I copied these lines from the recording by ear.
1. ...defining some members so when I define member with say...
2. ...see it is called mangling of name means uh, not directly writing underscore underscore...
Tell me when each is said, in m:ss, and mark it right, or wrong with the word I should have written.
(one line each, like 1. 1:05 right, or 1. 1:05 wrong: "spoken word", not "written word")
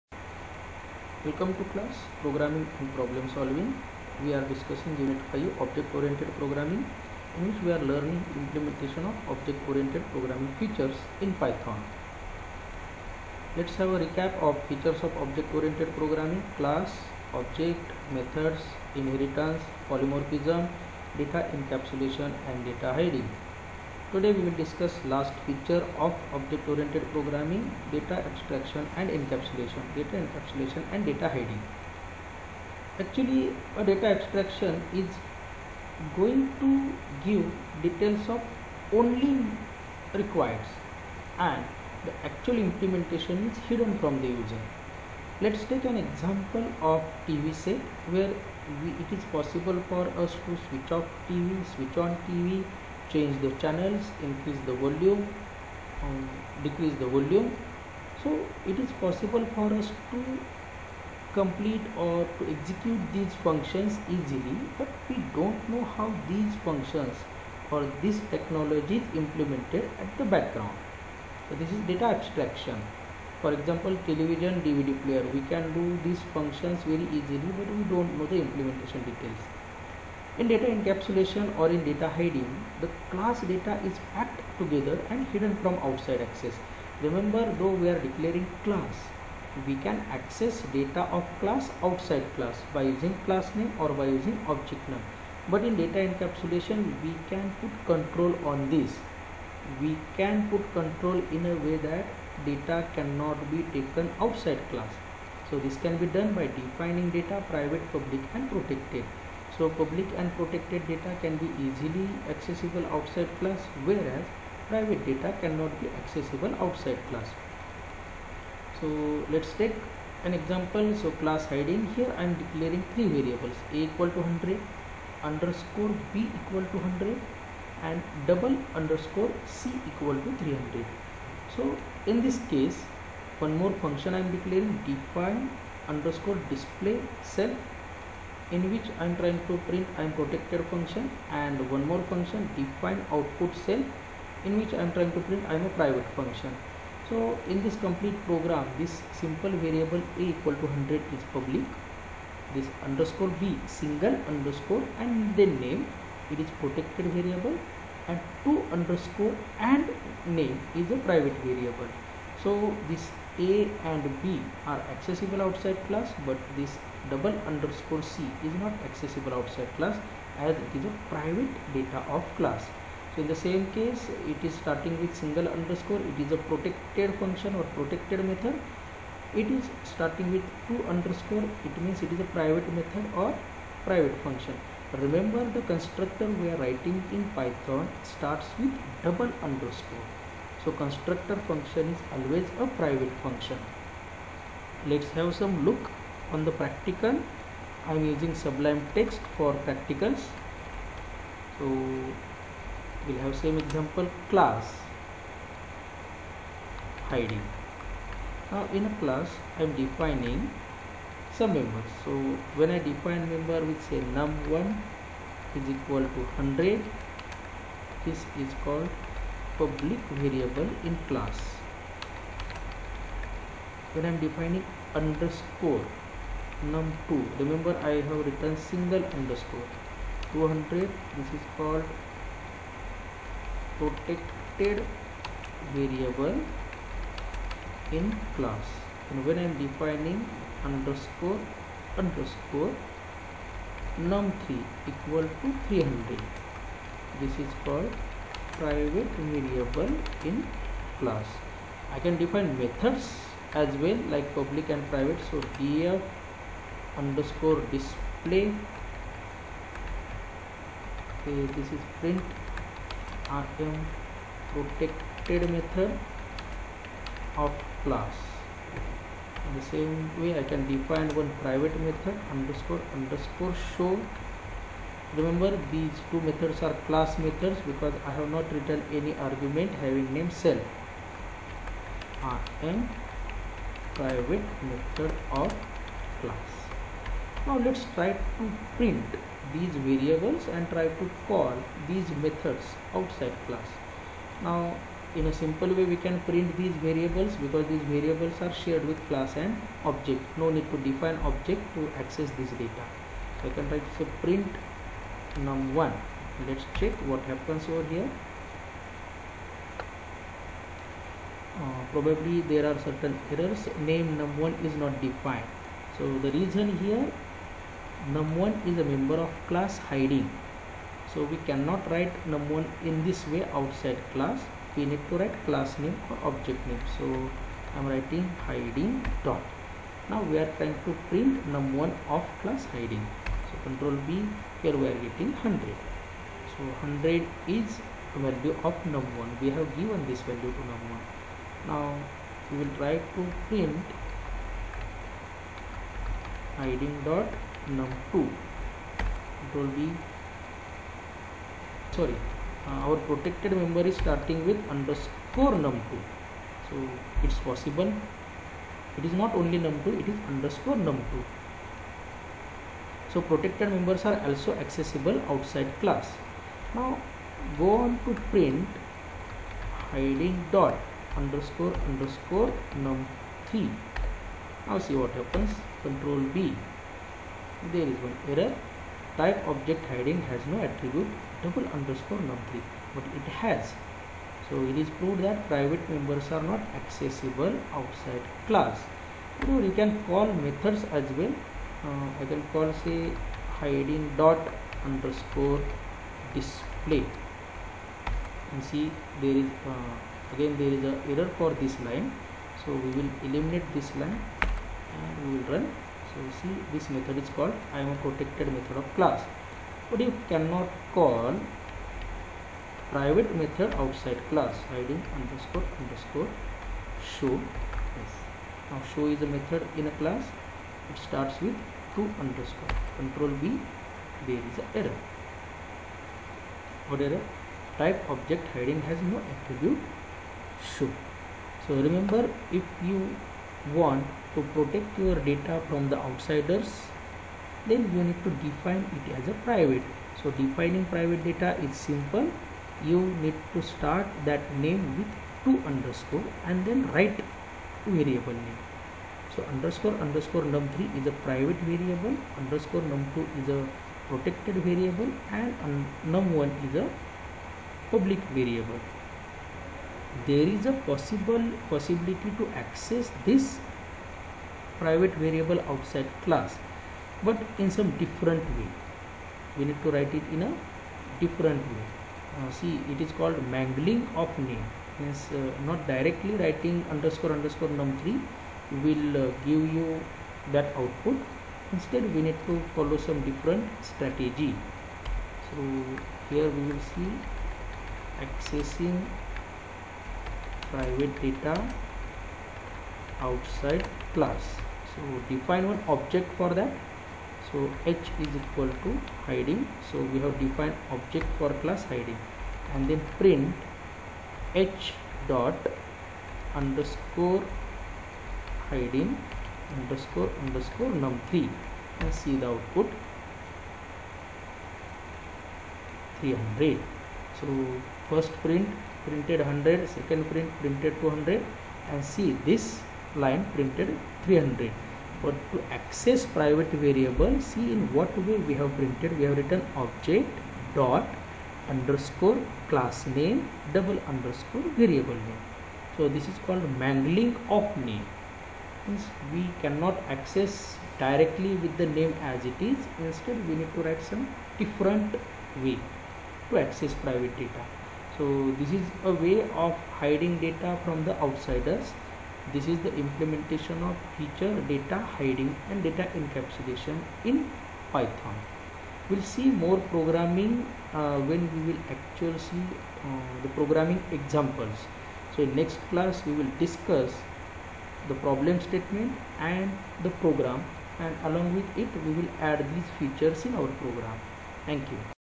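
1. 3:29 right
2. 7:52 right.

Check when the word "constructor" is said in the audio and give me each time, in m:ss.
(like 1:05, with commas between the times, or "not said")
3:05, 3:10.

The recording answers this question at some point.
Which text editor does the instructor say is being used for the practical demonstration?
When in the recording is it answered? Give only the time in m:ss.
3:18.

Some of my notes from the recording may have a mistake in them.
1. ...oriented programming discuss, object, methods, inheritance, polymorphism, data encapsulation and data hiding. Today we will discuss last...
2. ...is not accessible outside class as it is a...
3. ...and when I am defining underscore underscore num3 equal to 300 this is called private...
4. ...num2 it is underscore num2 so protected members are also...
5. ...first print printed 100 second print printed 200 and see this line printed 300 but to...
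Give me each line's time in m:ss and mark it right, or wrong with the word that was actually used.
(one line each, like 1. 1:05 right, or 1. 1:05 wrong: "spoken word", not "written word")
1. 0:15 wrong: "class", not "discuss"
2. 2:48 right
3. 3:59 right
4. 5:59 right
5. 8:38 right.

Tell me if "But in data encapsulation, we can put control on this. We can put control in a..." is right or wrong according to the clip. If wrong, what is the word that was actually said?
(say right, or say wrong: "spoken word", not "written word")
right.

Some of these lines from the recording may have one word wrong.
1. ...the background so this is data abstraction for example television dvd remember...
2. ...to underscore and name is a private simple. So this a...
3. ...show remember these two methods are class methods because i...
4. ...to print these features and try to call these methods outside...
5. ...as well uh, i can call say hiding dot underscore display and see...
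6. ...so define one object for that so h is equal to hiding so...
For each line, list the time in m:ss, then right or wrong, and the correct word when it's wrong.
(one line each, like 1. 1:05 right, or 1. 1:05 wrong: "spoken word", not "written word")
1. 1:10 wrong: "player", not "remember"
2. 2:38 wrong: "variable", not "simple"
3. 4:33 right
4. 4:48 wrong: "variables", not "features"
5. 6:30 right
6. 8:14 right.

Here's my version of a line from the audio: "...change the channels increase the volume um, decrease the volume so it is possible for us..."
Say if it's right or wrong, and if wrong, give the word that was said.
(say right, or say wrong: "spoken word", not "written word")
right.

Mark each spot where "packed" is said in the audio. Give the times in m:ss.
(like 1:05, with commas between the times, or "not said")
1:24.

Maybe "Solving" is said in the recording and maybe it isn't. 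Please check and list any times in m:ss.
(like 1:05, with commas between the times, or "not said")
0:03.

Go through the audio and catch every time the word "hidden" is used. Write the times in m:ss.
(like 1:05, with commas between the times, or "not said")
0:43, 1:25.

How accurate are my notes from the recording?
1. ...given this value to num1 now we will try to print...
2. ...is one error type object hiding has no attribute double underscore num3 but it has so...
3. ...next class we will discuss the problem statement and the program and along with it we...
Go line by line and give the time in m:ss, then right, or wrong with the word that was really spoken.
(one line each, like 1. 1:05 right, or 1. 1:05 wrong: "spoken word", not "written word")
1. 5:39 right
2. 6:17 right
3. 9:25 right.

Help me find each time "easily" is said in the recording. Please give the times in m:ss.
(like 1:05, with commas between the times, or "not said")
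1:04, 1:17, 1:51.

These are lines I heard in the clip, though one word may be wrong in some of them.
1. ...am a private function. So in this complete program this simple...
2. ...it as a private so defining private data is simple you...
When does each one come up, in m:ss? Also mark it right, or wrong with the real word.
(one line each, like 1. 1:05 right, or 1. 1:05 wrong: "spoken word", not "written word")
1. 2:25 right
2. 7:18 right.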